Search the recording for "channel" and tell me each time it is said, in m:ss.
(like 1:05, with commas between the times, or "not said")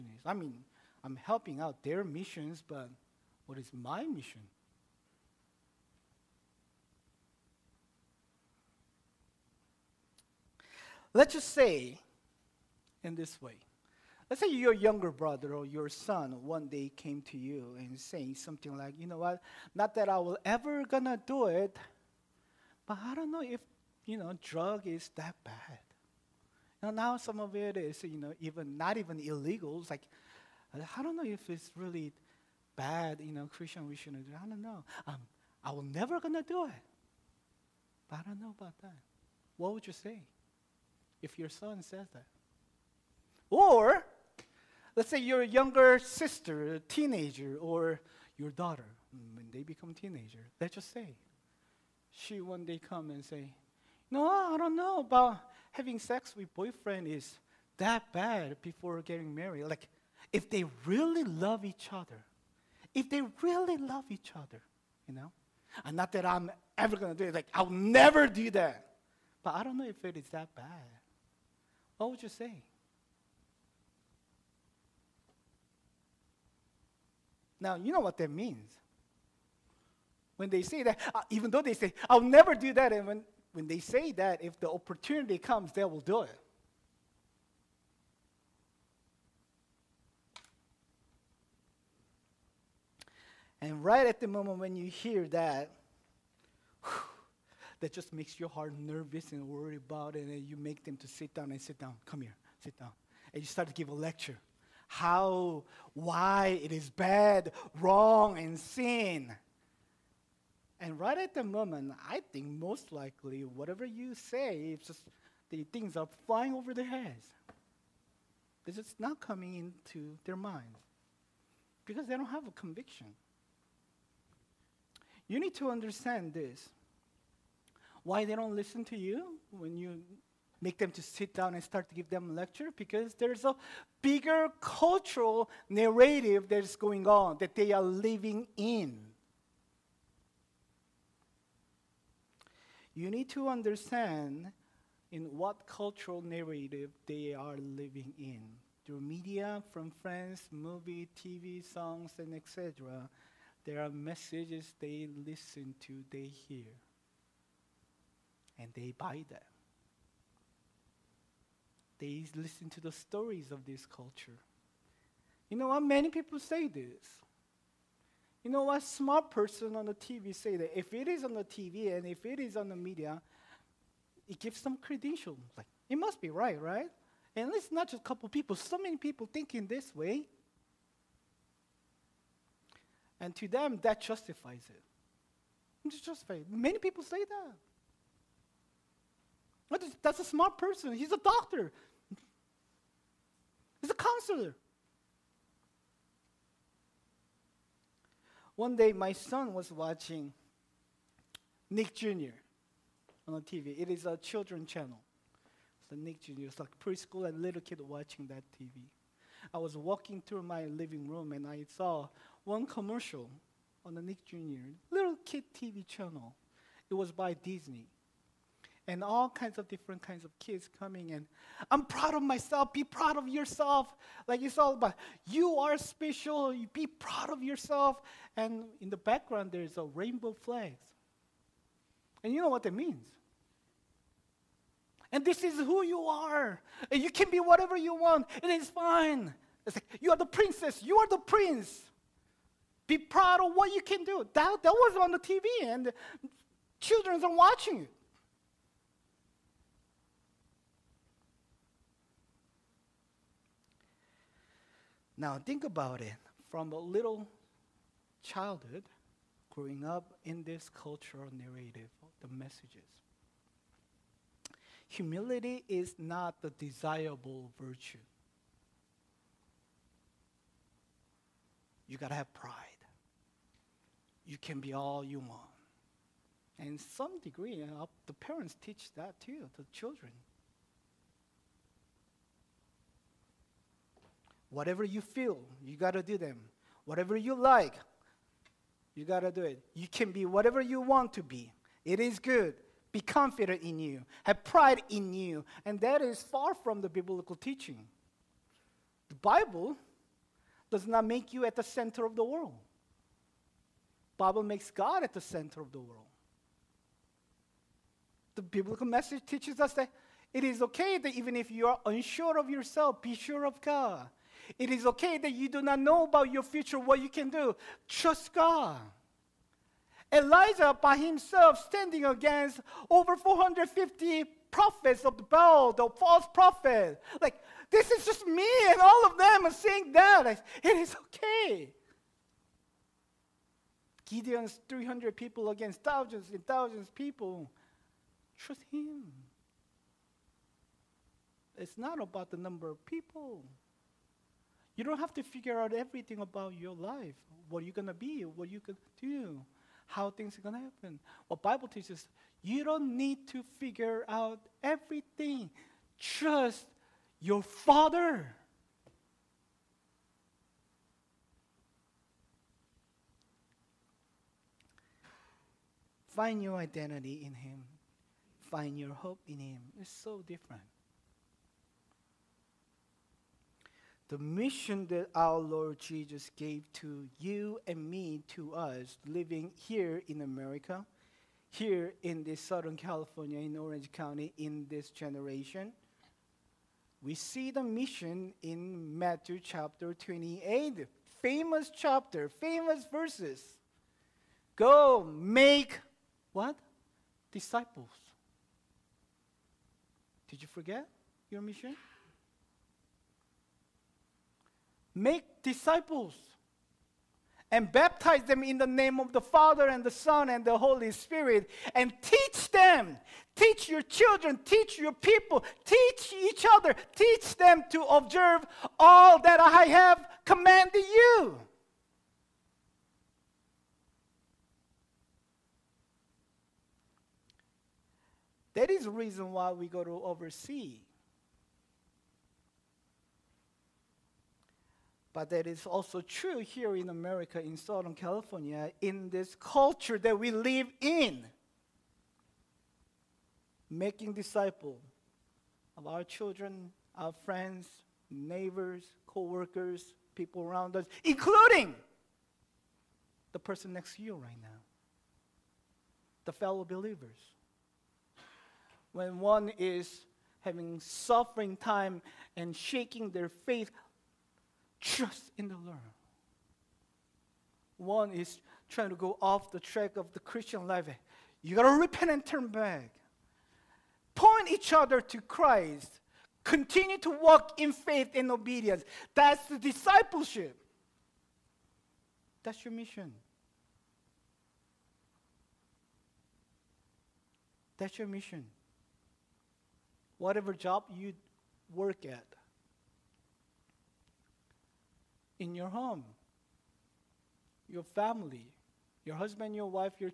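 3:24, 3:35.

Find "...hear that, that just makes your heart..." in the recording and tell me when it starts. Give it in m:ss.
1:34.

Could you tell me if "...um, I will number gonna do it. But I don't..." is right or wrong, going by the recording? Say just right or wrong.
wrong.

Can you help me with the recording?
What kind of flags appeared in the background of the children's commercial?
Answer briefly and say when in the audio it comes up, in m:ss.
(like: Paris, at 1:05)
Rainbow flags, at 3:49.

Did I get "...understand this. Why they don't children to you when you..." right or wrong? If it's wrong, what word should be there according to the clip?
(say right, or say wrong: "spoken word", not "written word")
wrong: "listen", not "children".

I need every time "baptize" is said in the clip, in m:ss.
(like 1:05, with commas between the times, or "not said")
6:47.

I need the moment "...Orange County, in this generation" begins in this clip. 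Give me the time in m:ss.
6:23.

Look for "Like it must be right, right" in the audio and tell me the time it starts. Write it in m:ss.
2:55.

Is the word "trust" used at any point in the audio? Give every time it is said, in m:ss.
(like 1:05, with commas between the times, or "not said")
5:17, 5:38, 5:55, 7:44.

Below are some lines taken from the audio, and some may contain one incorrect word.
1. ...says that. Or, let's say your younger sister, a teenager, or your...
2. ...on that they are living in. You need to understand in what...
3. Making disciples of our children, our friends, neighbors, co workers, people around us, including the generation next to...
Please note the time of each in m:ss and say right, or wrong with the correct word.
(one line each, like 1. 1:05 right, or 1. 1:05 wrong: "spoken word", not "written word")
1. 0:41 right
2. 2:17 right
3. 7:23 wrong: "person", not "generation".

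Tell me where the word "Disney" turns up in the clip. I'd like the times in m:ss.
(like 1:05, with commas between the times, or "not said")
3:37.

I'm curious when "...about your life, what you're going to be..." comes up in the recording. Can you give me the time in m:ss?
5:46.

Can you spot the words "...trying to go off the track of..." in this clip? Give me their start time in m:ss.
7:48.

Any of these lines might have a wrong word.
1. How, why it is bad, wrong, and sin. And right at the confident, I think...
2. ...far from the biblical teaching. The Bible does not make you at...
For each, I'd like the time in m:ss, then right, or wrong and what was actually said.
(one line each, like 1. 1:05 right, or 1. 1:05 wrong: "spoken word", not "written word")
1. 1:44 wrong: "moment", not "confident"
2. 4:56 right.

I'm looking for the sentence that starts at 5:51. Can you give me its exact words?
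What Bible teaches, you don't need to figure out everything.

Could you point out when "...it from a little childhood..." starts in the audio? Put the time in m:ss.
4:16.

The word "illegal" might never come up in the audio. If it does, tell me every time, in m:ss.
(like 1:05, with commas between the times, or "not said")
0:29.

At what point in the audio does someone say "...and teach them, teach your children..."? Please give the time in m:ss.
6:51.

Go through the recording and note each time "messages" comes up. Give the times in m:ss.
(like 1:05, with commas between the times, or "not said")
2:33, 4:22, 5:08.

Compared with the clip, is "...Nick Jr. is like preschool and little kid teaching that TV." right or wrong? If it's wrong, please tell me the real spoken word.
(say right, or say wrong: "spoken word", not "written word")
wrong: "watching", not "teaching".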